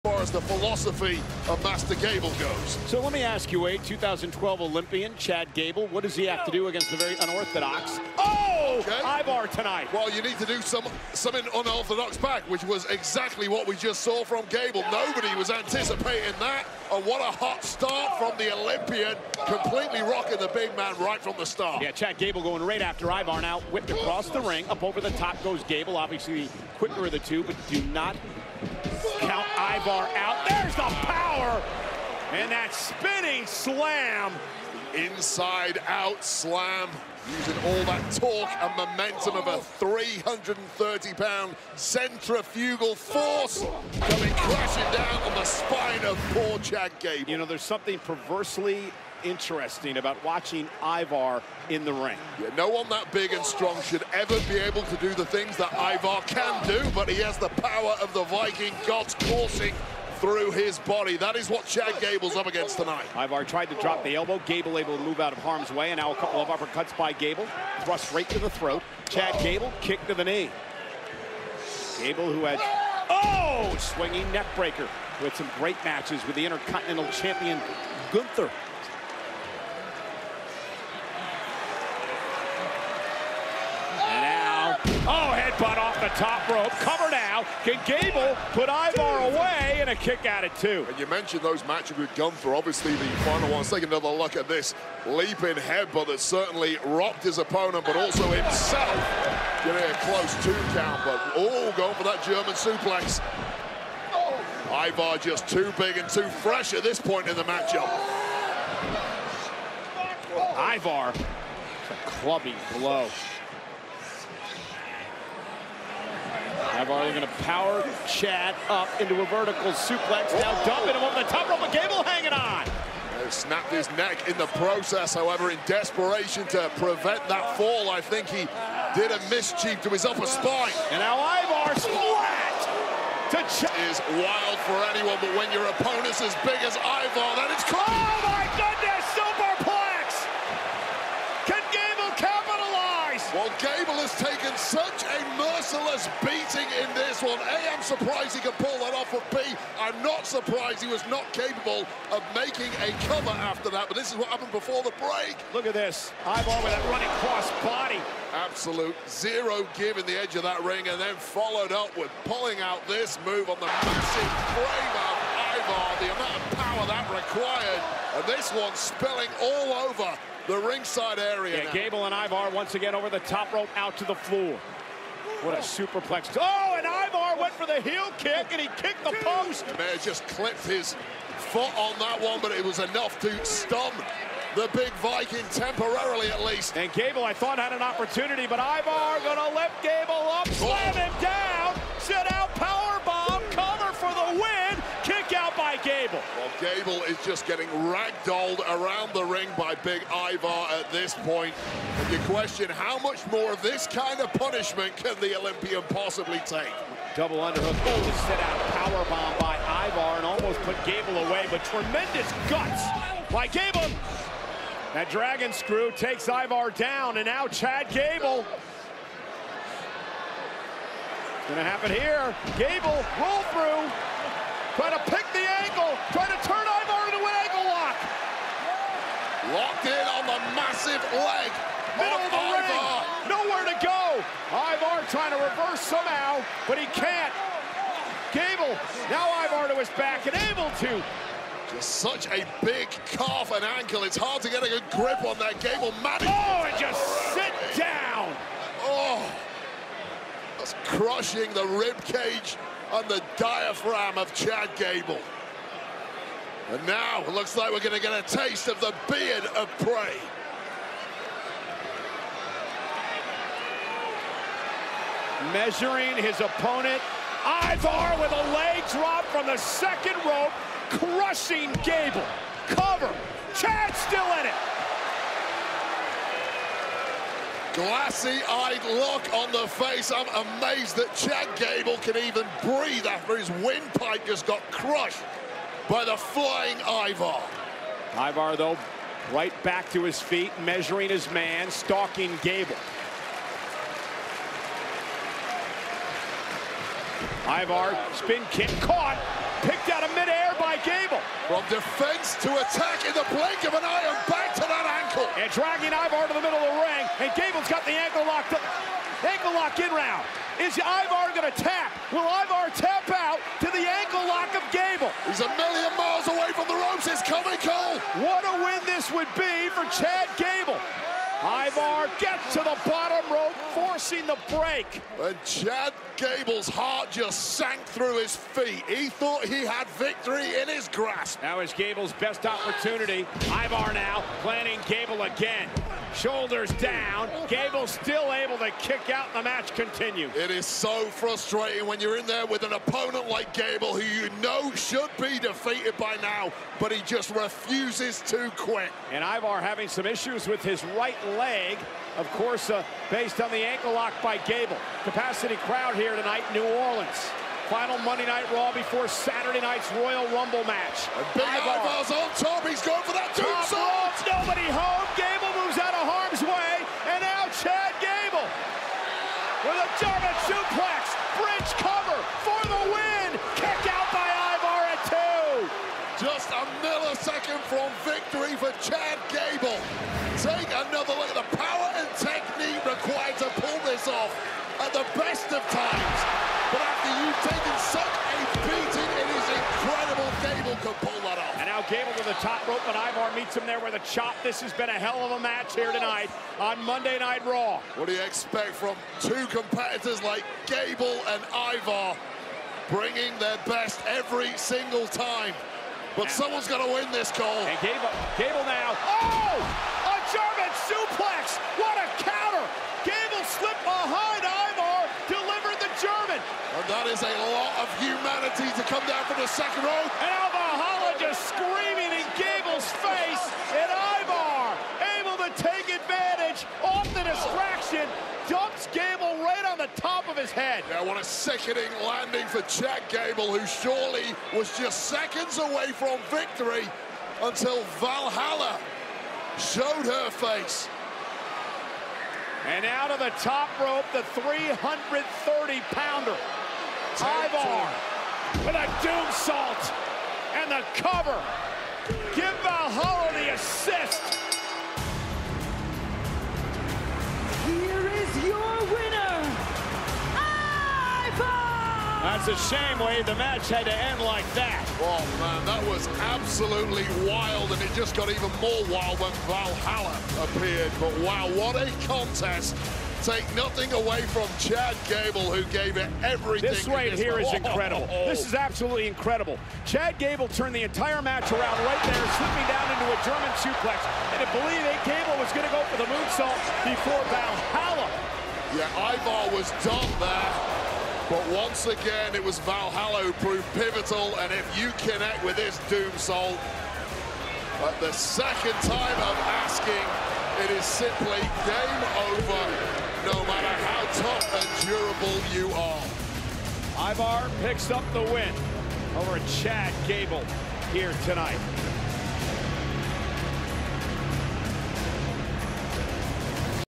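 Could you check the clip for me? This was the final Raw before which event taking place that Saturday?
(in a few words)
Royal Rumble.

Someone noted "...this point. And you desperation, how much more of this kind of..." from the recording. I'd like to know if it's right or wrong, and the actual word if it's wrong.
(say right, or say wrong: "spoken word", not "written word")
wrong: "question", not "desperation".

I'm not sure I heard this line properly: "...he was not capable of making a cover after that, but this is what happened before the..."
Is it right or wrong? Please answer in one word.
right.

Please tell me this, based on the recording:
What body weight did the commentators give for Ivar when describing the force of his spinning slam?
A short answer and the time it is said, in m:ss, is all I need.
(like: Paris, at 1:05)
330 pounds, at 0:39.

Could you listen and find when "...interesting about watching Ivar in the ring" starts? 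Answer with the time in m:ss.
0:49.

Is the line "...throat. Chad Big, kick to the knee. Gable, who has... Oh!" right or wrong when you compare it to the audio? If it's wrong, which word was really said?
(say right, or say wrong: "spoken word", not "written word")
wrong: "Gable", not "Big".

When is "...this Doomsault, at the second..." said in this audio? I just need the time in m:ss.
8:15.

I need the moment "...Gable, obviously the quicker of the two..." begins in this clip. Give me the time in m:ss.
0:25.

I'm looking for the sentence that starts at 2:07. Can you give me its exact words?
I think he did a mischief to his upper spine.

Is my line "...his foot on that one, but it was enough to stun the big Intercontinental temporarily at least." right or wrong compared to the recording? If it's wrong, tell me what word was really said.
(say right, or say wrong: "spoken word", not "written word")
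wrong: "Viking", not "Intercontinental".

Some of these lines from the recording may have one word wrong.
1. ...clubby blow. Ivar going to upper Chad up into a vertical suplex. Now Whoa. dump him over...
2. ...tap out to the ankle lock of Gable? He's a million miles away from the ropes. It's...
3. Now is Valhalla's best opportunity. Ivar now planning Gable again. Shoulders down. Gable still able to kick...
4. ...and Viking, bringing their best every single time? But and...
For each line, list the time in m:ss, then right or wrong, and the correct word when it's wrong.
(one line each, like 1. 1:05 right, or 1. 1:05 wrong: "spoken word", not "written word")
1. 1:52 wrong: "power", not "upper"
2. 5:12 right
3. 5:31 wrong: "Gable", not "Valhalla"
4. 6:41 wrong: "Ivar", not "Viking".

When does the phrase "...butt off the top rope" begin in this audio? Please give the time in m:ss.
1:25.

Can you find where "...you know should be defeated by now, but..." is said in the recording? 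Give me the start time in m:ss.
5:44.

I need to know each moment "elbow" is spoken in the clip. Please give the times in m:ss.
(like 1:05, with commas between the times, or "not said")
1:04.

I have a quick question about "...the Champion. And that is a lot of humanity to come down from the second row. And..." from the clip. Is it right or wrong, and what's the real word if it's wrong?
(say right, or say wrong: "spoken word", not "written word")
wrong: "German", not "Champion".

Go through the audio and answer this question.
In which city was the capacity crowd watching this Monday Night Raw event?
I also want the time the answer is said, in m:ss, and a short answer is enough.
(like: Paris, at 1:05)
New Orleans, at 5:56.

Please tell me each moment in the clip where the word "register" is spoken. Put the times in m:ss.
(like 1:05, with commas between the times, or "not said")
not said.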